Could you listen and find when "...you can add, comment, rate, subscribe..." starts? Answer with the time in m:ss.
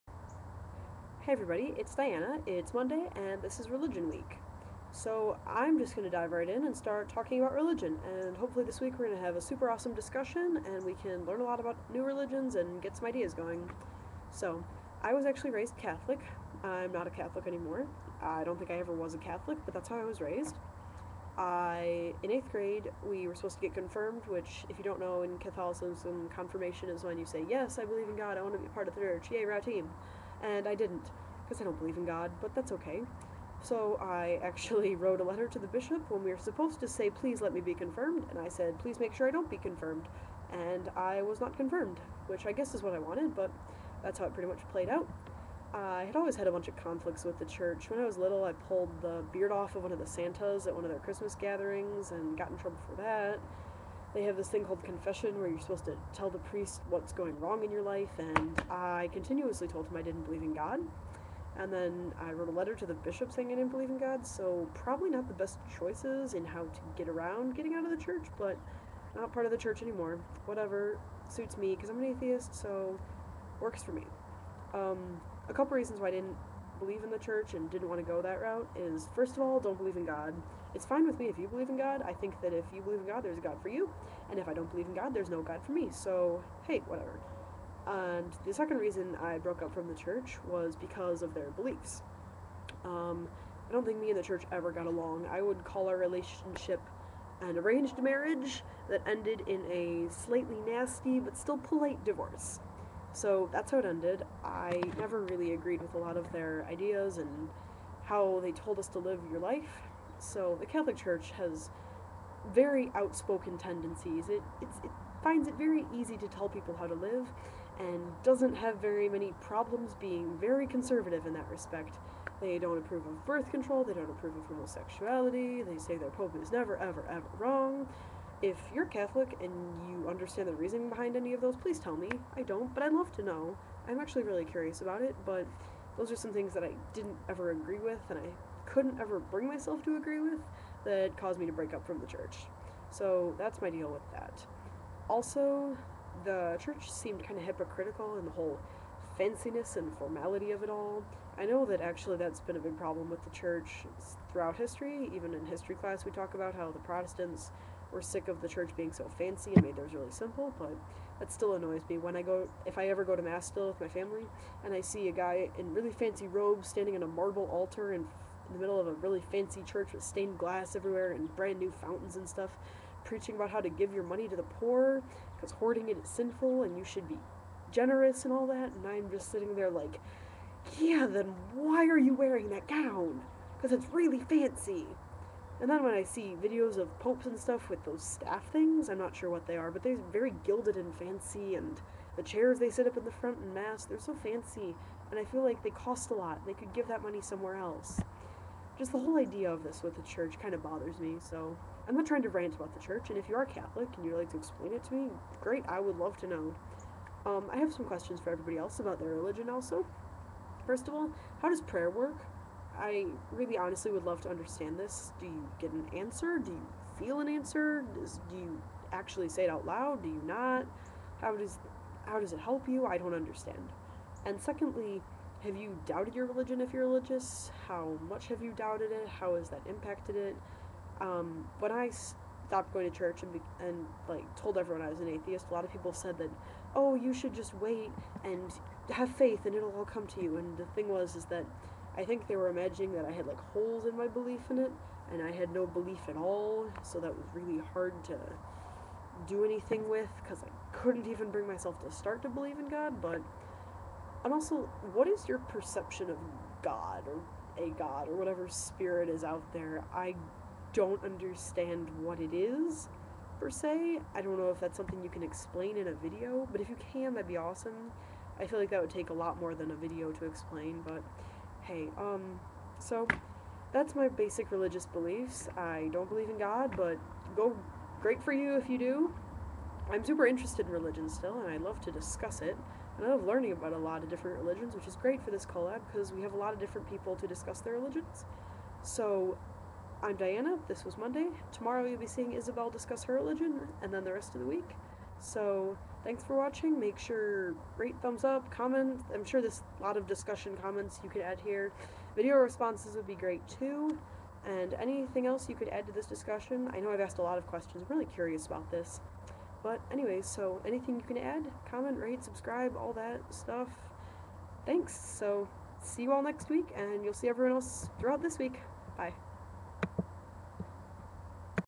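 5:10.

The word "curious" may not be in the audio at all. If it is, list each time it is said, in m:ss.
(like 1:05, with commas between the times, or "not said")
2:14, 5:08.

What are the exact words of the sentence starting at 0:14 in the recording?
So I was actually raised Catholic.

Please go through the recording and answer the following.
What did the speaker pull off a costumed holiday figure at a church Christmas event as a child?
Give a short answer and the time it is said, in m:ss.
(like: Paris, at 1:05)
The beard, at 0:49.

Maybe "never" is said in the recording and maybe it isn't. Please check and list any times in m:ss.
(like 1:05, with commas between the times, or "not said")
1:44, 2:06.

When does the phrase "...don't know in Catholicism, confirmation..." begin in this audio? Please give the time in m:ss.
0:24.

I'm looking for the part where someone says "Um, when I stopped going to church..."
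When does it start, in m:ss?
3:50.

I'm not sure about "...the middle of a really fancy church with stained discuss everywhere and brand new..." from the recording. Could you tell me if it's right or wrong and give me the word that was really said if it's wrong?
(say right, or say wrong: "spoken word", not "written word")
wrong: "glass", not "discuss".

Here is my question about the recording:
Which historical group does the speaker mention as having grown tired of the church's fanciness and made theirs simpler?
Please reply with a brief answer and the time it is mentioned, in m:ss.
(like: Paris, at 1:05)
The Protestants, at 2:36.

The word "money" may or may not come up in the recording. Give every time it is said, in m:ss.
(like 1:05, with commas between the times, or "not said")
2:54, 3:17.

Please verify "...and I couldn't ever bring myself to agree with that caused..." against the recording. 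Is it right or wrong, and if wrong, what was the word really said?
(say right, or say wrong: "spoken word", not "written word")
right.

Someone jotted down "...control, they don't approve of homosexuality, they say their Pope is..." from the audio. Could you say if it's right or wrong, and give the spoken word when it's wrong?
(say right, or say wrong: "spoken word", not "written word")
right.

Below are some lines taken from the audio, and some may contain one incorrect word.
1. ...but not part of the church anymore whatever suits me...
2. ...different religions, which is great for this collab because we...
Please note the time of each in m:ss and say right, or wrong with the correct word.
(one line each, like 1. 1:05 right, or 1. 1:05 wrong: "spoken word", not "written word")
1. 1:08 right
2. 4:44 right.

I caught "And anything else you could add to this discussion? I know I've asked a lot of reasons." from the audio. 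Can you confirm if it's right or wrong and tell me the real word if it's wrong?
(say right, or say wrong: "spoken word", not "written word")
wrong: "questions", not "reasons".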